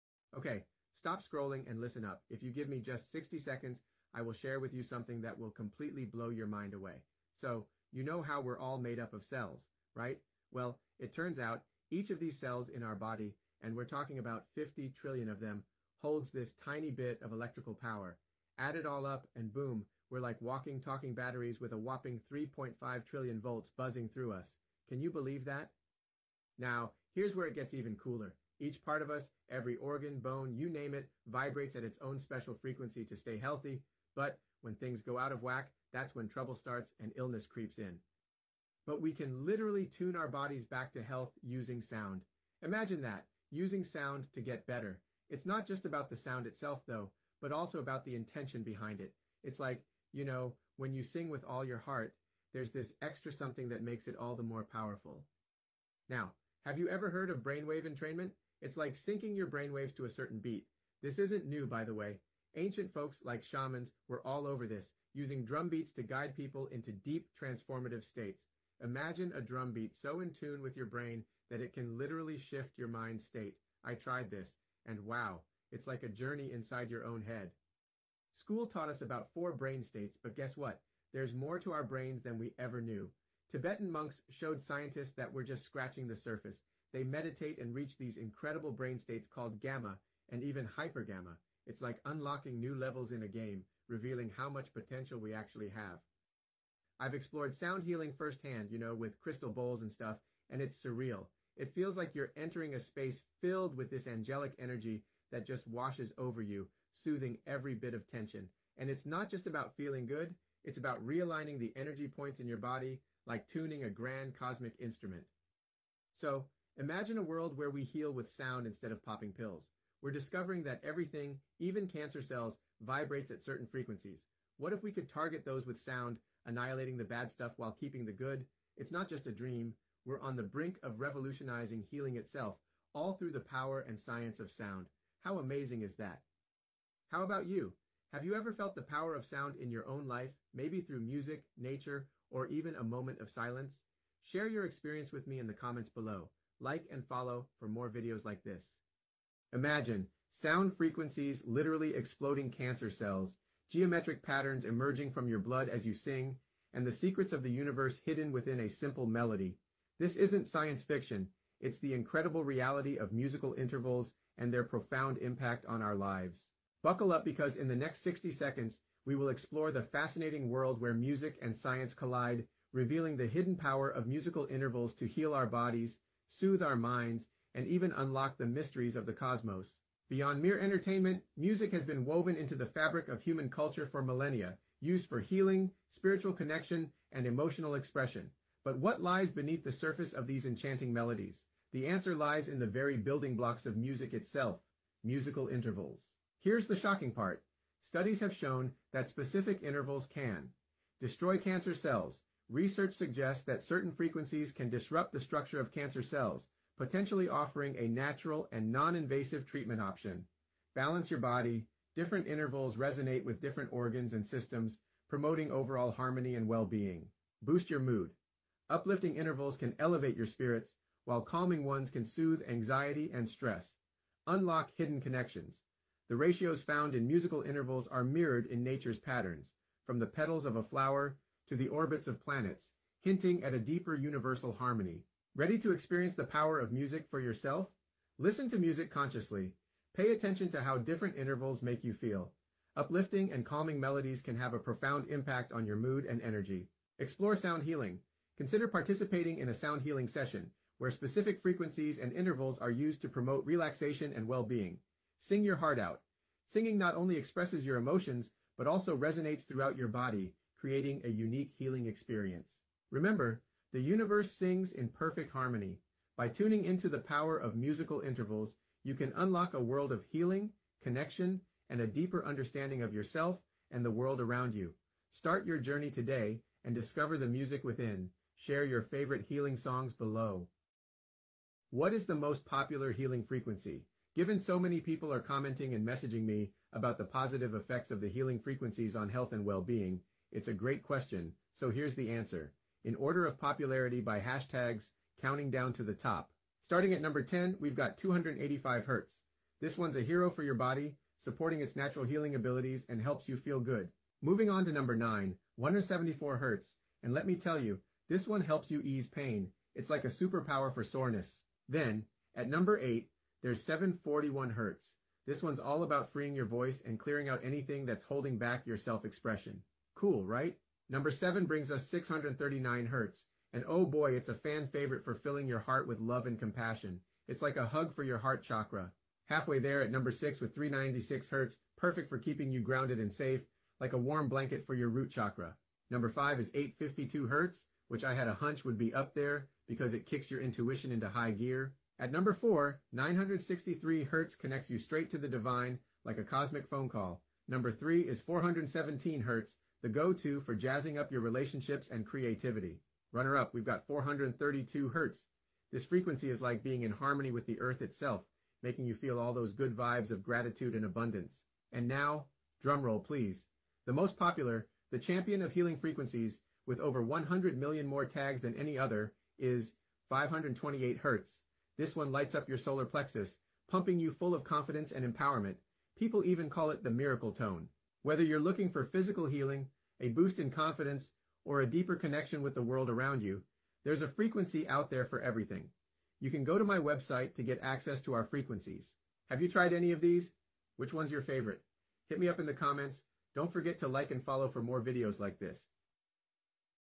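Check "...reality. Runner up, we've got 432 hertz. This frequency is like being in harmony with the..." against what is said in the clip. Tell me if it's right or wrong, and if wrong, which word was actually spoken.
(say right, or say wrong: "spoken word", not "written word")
wrong: "creativity", not "reality".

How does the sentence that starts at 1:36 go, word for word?
I've explored sound healing firsthand, you know, with crystal bowls and stuff, and it's surreal.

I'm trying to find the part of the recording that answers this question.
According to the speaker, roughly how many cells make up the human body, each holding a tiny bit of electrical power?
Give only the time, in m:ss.
0:14.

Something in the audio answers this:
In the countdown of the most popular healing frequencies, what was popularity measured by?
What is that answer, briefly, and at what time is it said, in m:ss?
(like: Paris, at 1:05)
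hashtags, at 4:54.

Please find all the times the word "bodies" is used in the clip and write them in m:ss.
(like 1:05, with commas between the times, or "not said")
0:40, 2:55.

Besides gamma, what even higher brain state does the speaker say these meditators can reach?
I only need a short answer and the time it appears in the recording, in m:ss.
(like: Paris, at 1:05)
hypergamma, at 1:30.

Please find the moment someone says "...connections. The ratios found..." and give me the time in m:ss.
3:45.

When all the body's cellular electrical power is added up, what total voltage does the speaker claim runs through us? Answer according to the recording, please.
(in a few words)
3.5 trillion volts.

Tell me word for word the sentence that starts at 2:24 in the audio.
Share your experience with me in the comments below like and follow for more videos like this.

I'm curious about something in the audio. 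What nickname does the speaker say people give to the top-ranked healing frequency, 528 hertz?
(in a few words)
the miracle tone.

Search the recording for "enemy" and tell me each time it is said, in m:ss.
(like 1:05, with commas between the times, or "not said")
not said.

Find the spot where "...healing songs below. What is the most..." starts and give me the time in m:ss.
4:39.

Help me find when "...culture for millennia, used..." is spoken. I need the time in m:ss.
3:03.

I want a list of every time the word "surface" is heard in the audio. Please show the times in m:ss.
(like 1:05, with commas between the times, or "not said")
1:26, 3:09.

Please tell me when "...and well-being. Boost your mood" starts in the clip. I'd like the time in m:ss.
3:36.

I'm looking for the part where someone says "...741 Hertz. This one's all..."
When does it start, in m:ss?
5:13.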